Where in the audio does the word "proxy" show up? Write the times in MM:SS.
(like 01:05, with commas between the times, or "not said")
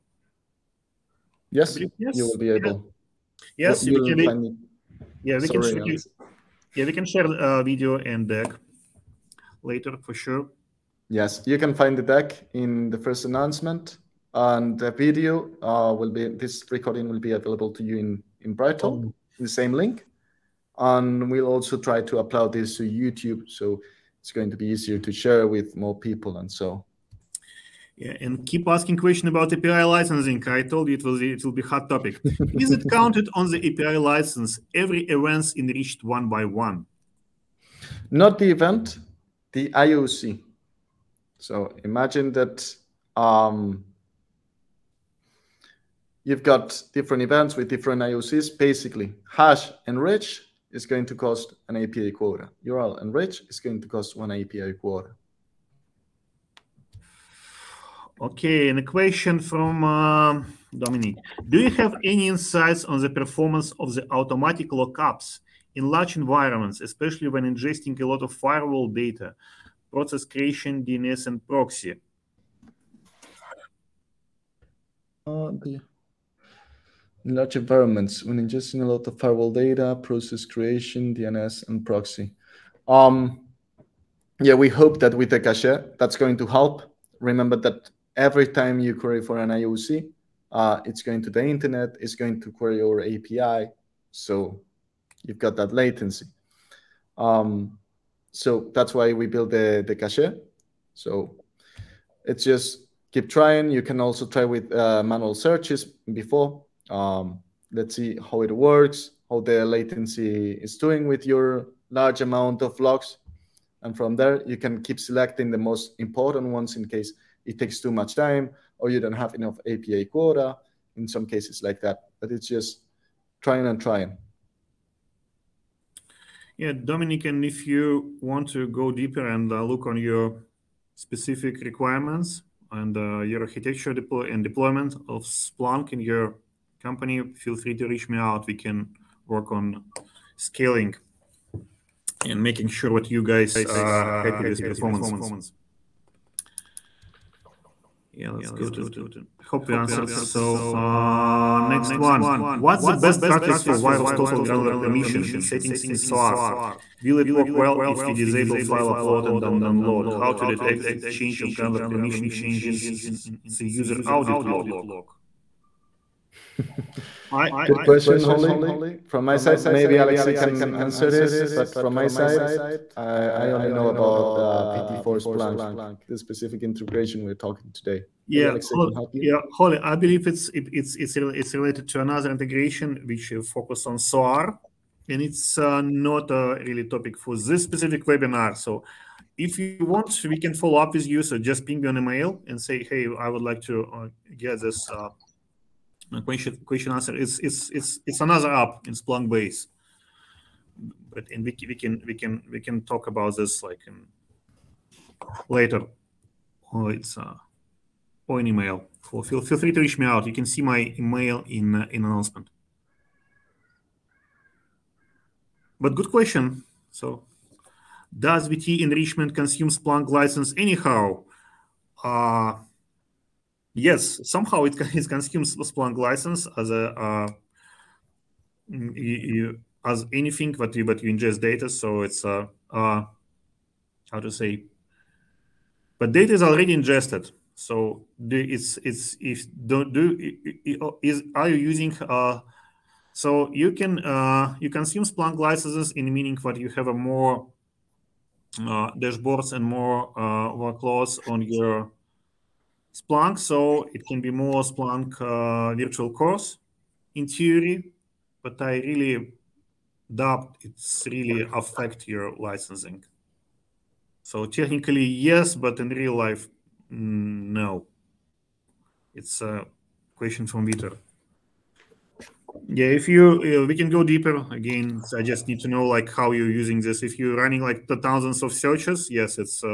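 01:11, 01:21.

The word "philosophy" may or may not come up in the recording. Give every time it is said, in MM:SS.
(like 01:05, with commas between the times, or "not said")
not said.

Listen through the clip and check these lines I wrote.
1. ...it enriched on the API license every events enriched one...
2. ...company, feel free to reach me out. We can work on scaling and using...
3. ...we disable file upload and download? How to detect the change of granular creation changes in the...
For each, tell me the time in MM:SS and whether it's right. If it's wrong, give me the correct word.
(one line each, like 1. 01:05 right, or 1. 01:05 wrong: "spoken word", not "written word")
1. 00:32 wrong: "counted", not "enriched"
2. 02:16 wrong: "making", not "using"
3. 02:38 wrong: "permission", not "creation".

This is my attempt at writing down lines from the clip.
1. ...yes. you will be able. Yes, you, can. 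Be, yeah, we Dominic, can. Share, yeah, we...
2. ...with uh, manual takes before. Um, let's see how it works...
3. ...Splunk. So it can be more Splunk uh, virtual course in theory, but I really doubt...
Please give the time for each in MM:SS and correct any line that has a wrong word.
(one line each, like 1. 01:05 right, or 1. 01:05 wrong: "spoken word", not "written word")
1. 00:01 wrong: "Sorry", not "Dominic"
2. 01:44 wrong: "searches", not "takes"
3. 04:12 right.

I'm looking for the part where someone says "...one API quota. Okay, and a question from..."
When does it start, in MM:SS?
00:54.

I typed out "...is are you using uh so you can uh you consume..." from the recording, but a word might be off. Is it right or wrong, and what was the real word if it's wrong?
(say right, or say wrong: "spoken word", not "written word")
right.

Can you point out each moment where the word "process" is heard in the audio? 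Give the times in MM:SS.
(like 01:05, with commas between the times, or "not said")
01:09, 01:20.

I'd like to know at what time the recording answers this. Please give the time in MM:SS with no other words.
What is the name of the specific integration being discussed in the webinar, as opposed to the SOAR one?
02:54.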